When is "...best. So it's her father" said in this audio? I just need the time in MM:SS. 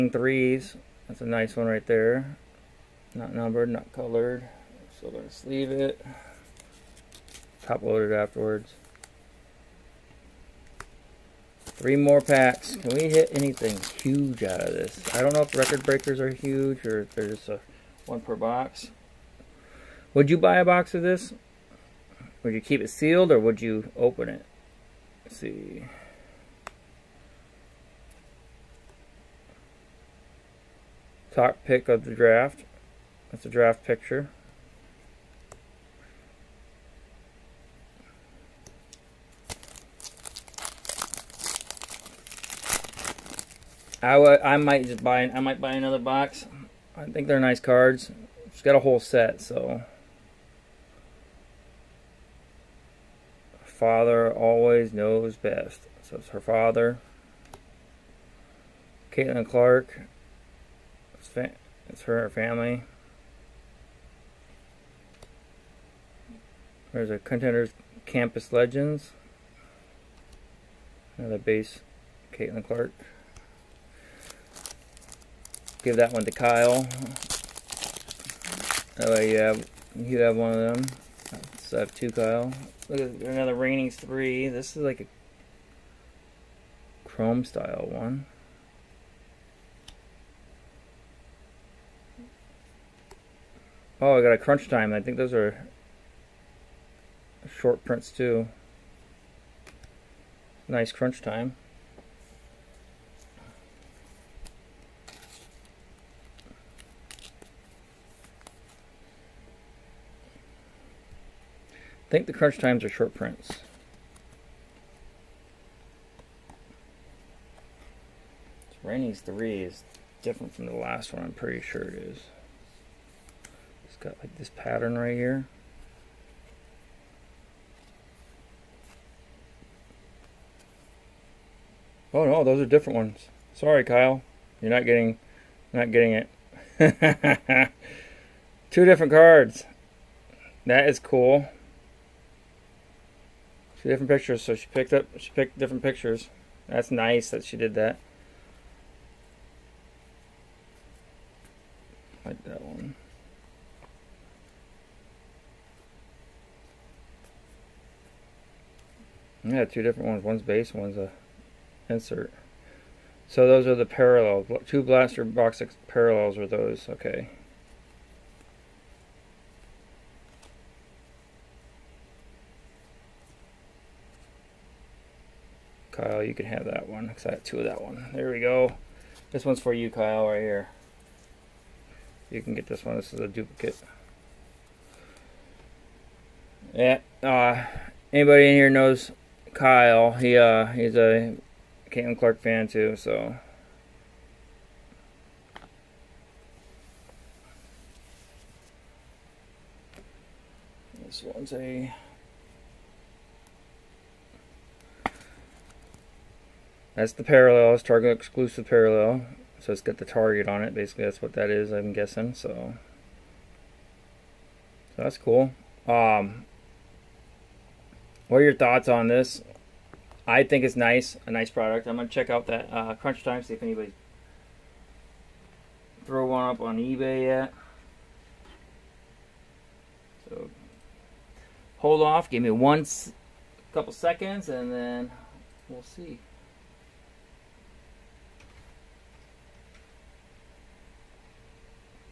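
00:55.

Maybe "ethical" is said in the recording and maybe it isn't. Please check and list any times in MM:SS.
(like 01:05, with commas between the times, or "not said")
not said.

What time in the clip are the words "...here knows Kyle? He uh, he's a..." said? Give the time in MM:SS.
03:08.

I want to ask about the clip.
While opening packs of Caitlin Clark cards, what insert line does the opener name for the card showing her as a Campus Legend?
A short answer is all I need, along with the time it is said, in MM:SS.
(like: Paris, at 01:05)
Contenders, at 01:07.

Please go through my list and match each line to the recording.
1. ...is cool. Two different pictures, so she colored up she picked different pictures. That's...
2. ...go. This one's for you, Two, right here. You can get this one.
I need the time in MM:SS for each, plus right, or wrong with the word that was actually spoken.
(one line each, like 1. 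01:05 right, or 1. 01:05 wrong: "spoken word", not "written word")
1. 02:20 wrong: "picked", not "colored"
2. 02:58 wrong: "Kyle", not "Two".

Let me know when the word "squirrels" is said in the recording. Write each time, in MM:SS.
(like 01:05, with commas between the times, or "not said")
not said.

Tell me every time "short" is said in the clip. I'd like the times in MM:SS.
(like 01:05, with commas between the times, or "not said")
01:37, 01:52.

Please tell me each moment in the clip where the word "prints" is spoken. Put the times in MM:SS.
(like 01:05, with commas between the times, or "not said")
01:37, 01:53.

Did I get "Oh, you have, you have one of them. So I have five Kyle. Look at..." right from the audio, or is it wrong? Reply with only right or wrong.
wrong.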